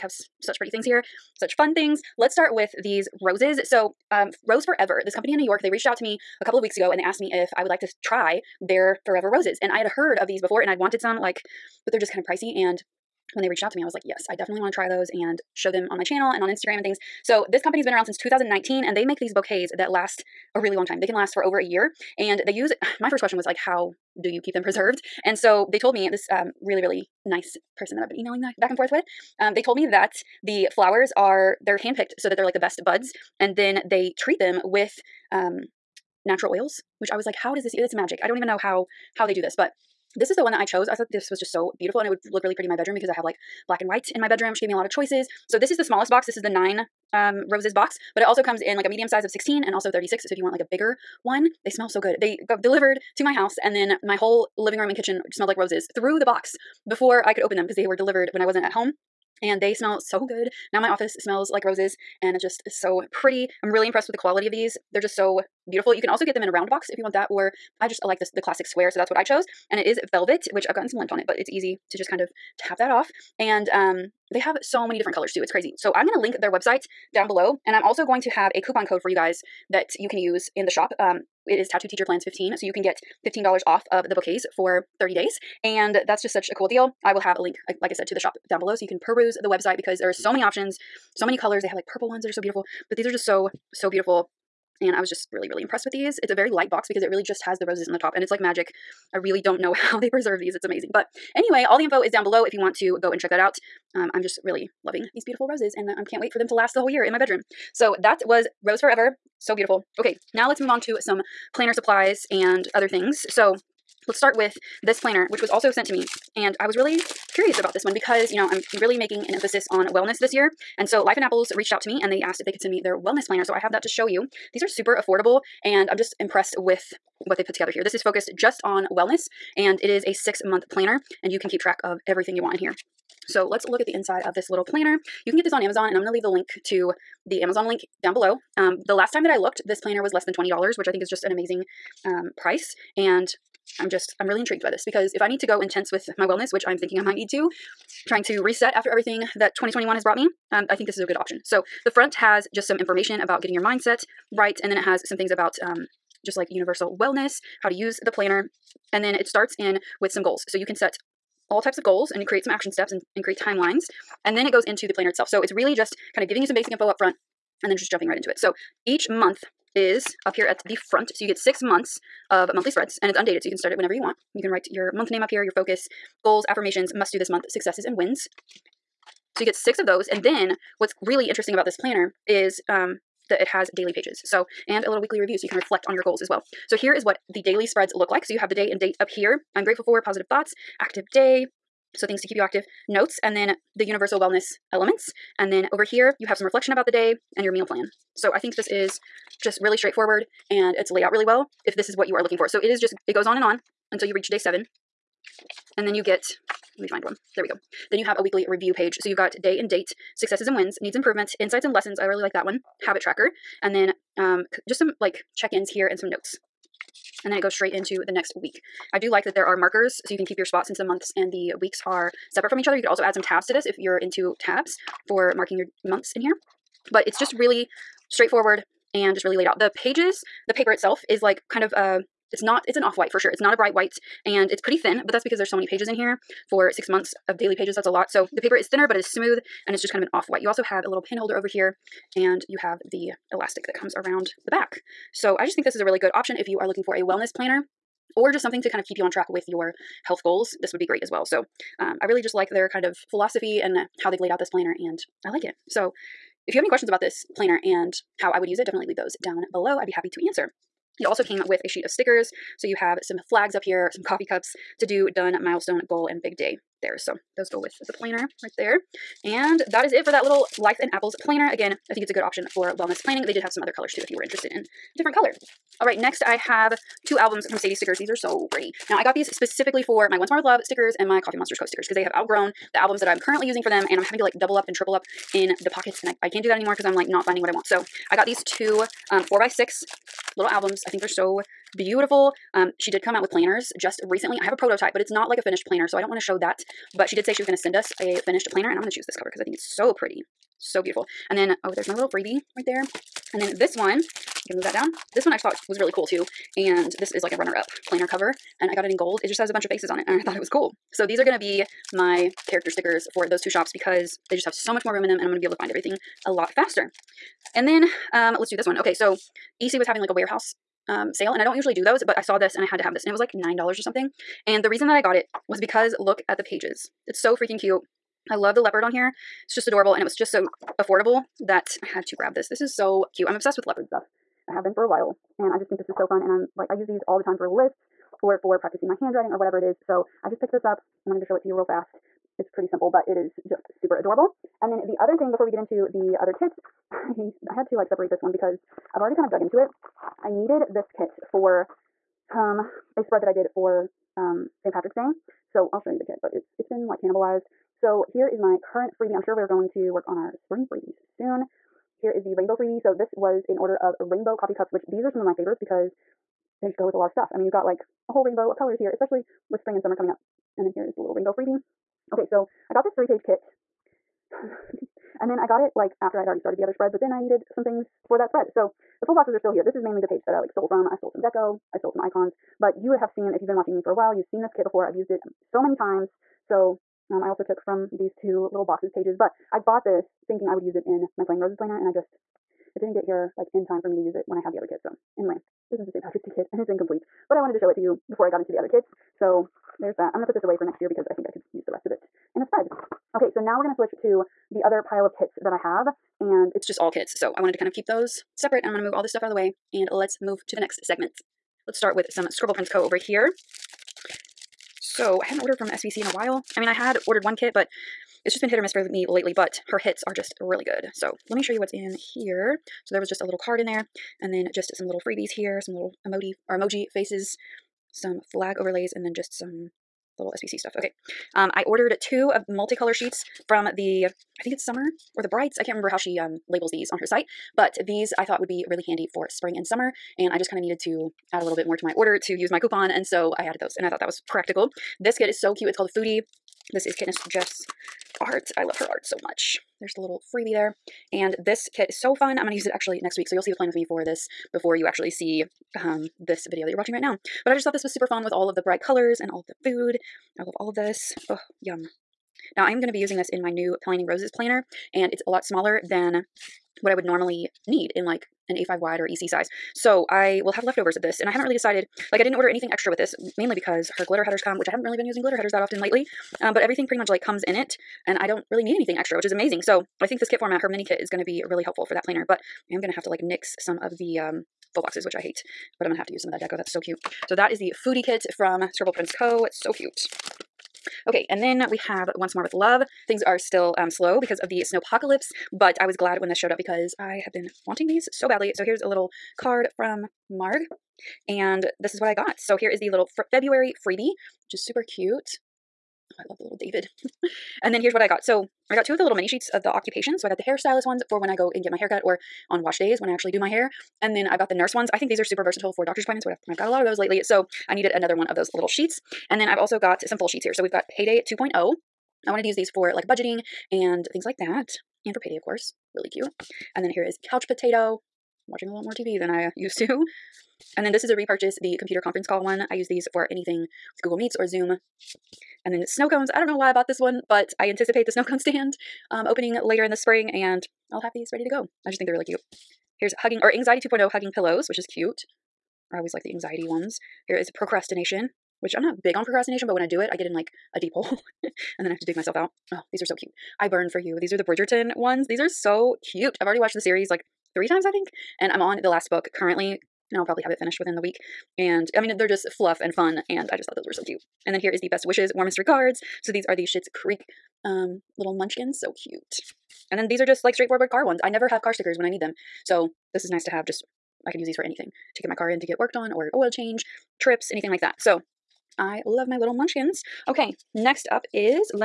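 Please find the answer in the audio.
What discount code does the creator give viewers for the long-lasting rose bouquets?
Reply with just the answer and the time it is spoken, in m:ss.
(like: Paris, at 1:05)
Tattooed Teacher Plans 15, at 1:21.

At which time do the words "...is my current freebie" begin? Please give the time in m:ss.
5:58.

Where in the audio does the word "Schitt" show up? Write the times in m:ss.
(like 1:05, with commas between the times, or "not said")
9:26.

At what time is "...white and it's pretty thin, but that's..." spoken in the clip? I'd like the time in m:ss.
3:53.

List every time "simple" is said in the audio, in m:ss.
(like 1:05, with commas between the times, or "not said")
5:42.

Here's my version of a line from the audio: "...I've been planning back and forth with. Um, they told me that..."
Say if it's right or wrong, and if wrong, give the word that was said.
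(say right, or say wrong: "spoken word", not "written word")
wrong: "emailing", not "planning".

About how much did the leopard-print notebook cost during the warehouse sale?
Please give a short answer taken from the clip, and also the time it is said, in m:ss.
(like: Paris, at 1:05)
$9, at 5:23.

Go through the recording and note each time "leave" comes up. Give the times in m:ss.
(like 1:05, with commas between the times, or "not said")
2:16, 4:18.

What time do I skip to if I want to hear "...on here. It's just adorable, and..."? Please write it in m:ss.
5:28.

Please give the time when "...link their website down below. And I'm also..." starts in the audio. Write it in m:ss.
1:16.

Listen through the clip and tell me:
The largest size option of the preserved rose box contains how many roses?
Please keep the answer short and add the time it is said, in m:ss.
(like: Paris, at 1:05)
36, at 0:49.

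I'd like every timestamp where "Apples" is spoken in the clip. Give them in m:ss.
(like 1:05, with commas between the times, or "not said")
2:01, 4:30.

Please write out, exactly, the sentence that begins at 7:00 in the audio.
So let me show you what's in here.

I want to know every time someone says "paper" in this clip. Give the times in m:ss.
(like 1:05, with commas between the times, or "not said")
3:50, 3:58.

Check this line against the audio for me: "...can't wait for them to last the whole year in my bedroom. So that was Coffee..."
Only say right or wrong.
wrong.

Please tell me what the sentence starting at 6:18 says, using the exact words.
So the full boxes are still here.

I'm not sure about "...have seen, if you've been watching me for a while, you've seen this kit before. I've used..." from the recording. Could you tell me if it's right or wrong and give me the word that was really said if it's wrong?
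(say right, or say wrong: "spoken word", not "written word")
right.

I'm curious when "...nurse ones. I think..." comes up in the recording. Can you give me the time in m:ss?
8:34.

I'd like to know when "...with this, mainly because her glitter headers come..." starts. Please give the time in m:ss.
7:52.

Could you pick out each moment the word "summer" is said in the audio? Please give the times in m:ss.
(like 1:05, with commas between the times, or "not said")
6:09, 7:14, 7:19.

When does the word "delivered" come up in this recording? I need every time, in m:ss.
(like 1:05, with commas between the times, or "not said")
0:52, 0:57.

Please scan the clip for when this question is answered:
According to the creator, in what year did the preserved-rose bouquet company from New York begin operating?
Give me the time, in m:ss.
0:18.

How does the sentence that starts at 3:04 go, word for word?
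So, and a little weekly review so you can reflect on your goals as well.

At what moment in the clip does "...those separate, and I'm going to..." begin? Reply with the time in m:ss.
6:47.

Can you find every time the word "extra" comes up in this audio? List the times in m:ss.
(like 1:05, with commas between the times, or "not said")
7:52, 7:58.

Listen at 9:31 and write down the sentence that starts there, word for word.
I never have car stickers when I need them.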